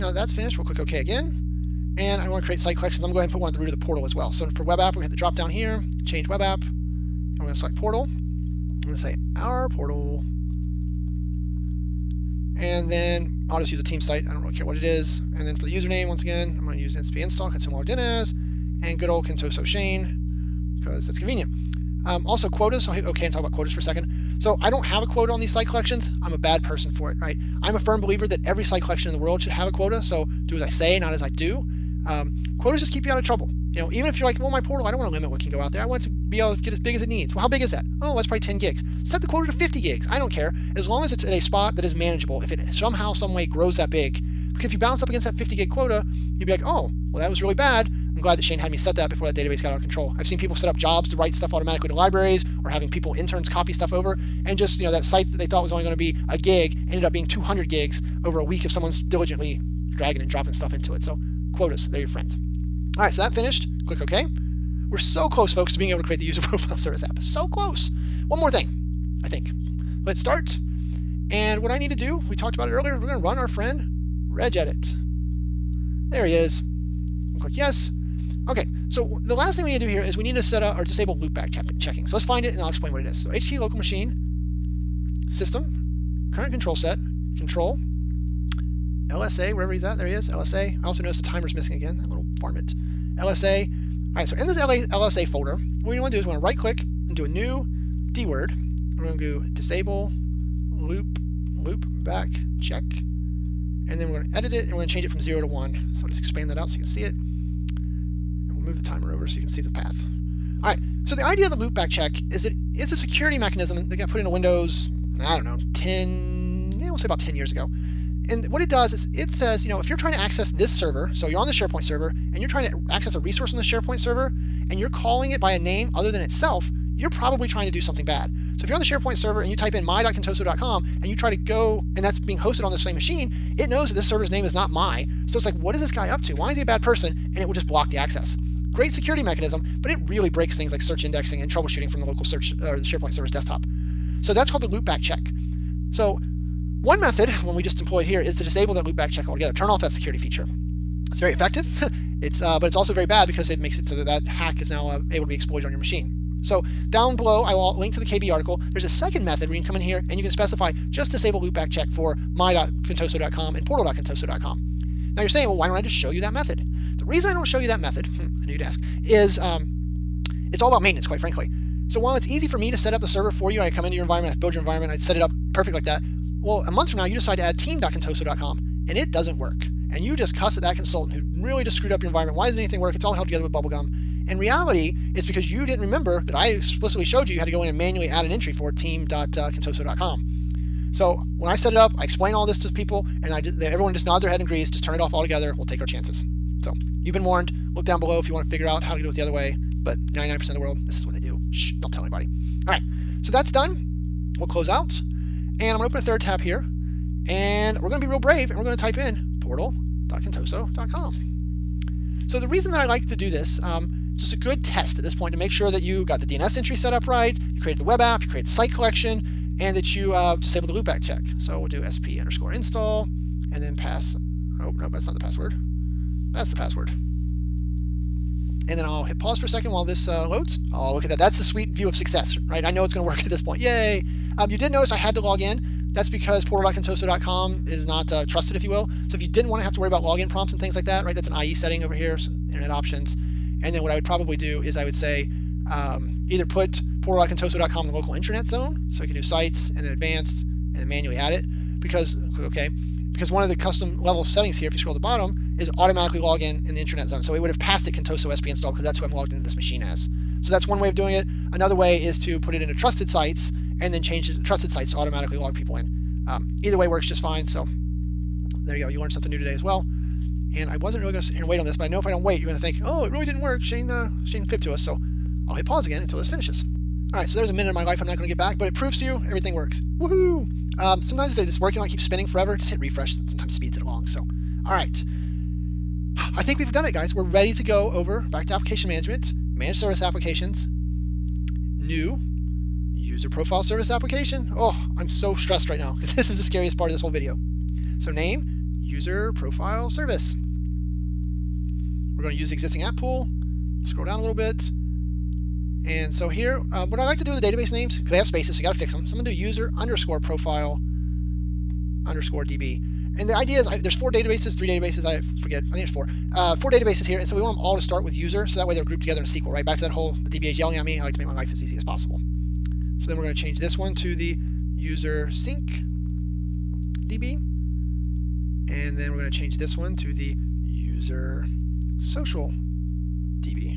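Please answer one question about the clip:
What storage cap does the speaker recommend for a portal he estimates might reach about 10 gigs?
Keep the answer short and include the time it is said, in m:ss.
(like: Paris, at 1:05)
50 gigs, at 0:39.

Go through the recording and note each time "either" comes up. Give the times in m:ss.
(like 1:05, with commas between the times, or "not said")
4:06, 4:26.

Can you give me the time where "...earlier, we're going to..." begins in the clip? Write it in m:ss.
1:12.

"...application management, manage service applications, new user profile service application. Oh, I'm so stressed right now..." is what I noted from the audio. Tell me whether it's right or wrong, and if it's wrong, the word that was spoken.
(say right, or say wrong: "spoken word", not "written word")
right.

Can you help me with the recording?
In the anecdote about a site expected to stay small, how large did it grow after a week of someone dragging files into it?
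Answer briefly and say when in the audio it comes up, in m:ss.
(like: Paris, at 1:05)
200 gigs, at 0:57.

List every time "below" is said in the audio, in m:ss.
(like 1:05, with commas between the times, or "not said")
2:37, 3:17.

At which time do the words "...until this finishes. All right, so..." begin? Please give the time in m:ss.
4:35.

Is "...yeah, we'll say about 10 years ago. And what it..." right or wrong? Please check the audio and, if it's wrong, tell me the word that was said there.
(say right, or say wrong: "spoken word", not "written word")
right.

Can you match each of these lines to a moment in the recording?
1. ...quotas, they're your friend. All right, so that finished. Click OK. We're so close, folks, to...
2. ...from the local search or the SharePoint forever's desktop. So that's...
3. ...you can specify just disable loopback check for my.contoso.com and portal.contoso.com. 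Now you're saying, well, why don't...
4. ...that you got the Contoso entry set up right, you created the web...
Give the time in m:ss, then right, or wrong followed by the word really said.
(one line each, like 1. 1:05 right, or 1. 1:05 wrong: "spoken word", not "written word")
1. 1:01 right
2. 2:21 wrong: "server", not "forever"
3. 2:40 right
4. 3:35 wrong: "DNS", not "Contoso".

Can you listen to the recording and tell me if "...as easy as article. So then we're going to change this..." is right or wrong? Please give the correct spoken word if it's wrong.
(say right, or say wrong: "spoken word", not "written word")
wrong: "possible", not "article".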